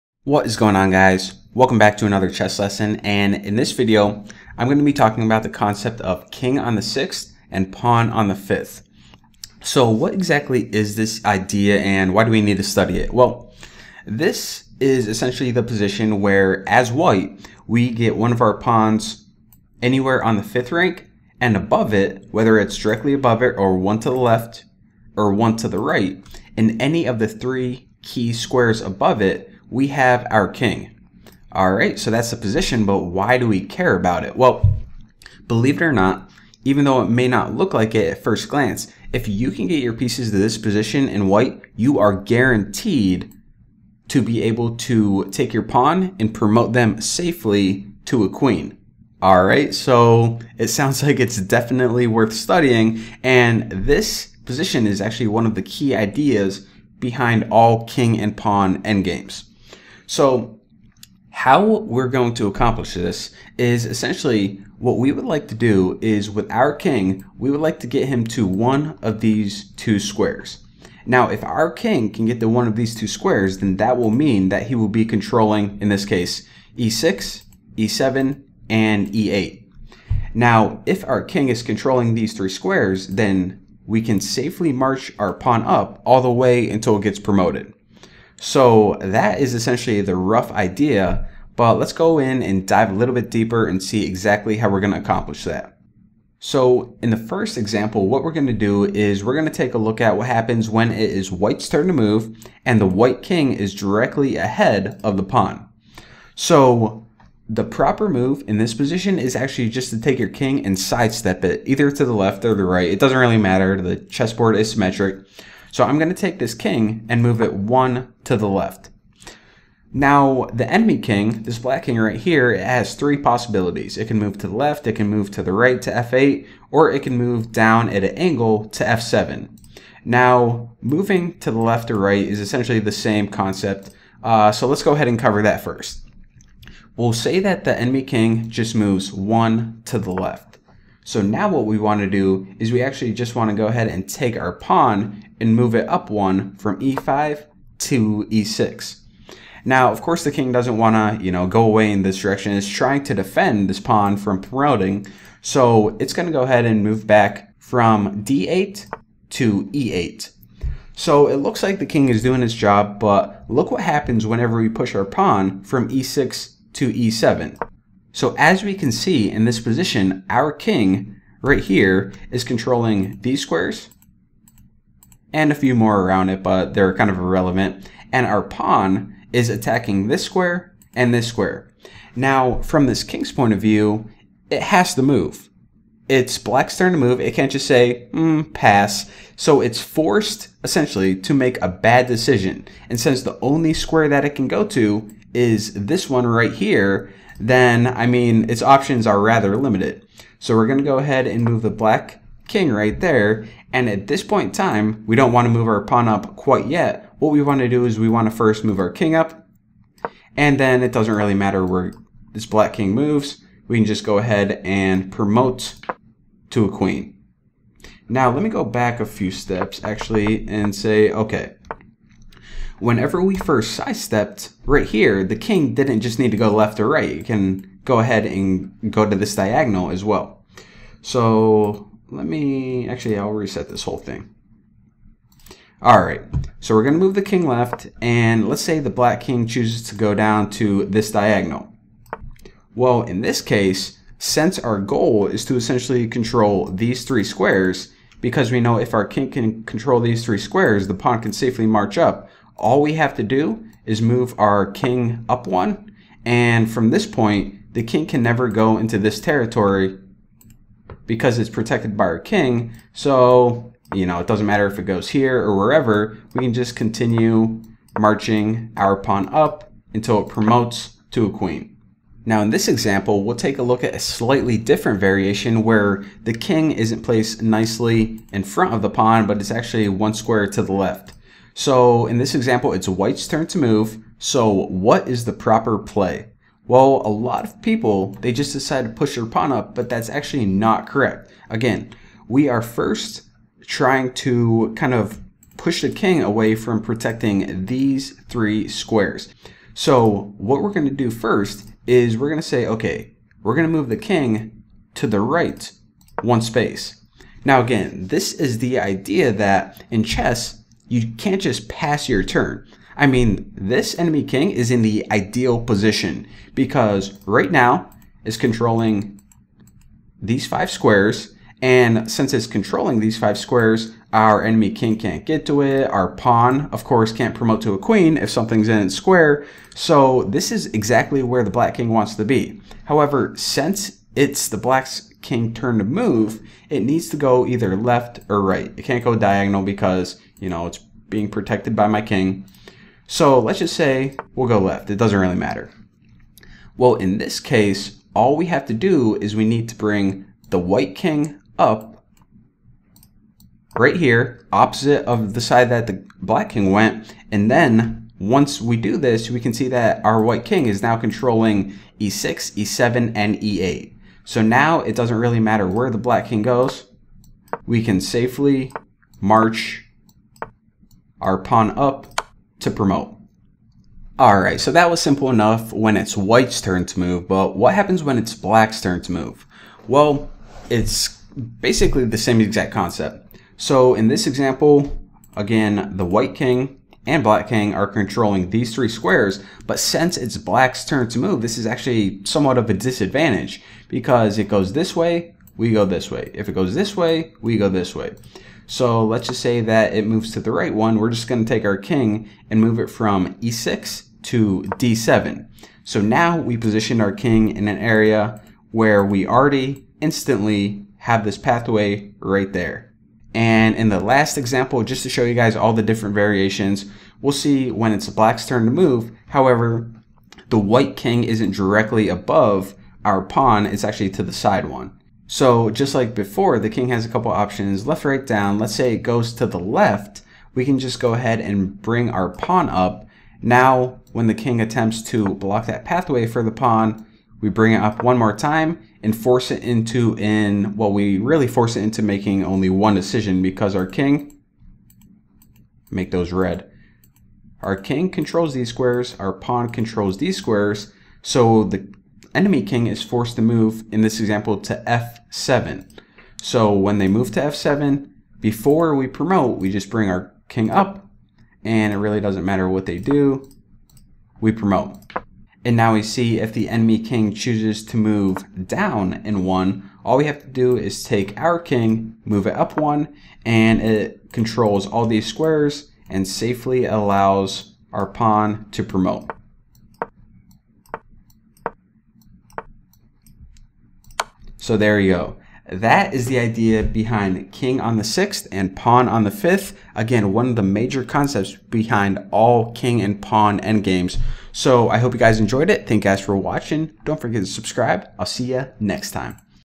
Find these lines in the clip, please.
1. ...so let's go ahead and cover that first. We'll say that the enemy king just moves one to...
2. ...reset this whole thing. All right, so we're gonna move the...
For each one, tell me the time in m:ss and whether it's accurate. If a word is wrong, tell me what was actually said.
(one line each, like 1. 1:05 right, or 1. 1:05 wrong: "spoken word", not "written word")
1. 2:14 right
2. 3:53 right.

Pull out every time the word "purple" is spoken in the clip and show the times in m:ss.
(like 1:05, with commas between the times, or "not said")
not said.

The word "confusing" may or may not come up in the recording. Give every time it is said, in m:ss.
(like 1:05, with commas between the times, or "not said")
not said.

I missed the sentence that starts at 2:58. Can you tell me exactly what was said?
And our pawn is attacking this square and this square.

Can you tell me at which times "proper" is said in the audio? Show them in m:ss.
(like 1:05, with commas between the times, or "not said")
1:47, 4:45.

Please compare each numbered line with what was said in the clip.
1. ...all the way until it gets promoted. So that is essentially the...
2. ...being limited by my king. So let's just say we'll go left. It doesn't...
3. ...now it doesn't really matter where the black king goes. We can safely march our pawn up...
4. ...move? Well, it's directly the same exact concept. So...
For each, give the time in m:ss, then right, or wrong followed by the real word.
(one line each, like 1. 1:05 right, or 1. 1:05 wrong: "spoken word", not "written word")
1. 1:26 right
2. 5:40 wrong: "protected", not "limited"
3. 6:04 right
4. 6:19 wrong: "basically", not "directly".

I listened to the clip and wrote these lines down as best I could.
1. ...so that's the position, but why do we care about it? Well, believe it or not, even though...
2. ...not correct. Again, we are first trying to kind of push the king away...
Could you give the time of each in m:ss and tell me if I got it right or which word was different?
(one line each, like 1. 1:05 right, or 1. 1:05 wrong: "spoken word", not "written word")
1. 0:31 right
2. 4:50 right.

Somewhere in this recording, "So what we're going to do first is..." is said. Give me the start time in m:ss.
4:59.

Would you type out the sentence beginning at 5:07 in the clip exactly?
Now again, this is the idea that in chess, you can't just pass your turn.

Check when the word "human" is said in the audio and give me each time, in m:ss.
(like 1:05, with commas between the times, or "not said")
not said.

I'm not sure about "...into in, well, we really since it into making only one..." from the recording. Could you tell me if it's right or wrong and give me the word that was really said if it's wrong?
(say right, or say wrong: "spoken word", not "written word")
wrong: "force", not "since".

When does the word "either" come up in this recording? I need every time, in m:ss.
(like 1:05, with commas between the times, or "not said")
1:51, 5:37.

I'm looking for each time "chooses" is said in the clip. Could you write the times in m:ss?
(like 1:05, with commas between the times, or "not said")
3:59, 7:47.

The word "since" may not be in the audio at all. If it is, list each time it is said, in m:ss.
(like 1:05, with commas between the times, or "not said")
3:12, 4:04, 5:22, 5:33, 6:29.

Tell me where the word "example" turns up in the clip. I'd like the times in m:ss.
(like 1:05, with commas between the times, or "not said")
1:37, 4:32, 4:42, 6:24, 6:54, 7:34.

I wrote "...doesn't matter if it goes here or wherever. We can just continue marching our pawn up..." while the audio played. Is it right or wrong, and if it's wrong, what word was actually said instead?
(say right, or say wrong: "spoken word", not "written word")
right.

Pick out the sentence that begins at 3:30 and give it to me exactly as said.
And then it doesn't really matter where this black king moves.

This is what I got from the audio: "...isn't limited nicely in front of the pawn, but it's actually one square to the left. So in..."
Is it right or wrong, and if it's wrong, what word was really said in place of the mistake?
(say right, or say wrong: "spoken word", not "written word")
wrong: "placed", not "limited".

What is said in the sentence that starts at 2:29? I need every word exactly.
Now, of course, the king doesn't want to, you know, go away in this direction.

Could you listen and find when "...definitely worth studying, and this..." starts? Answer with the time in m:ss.
0:51.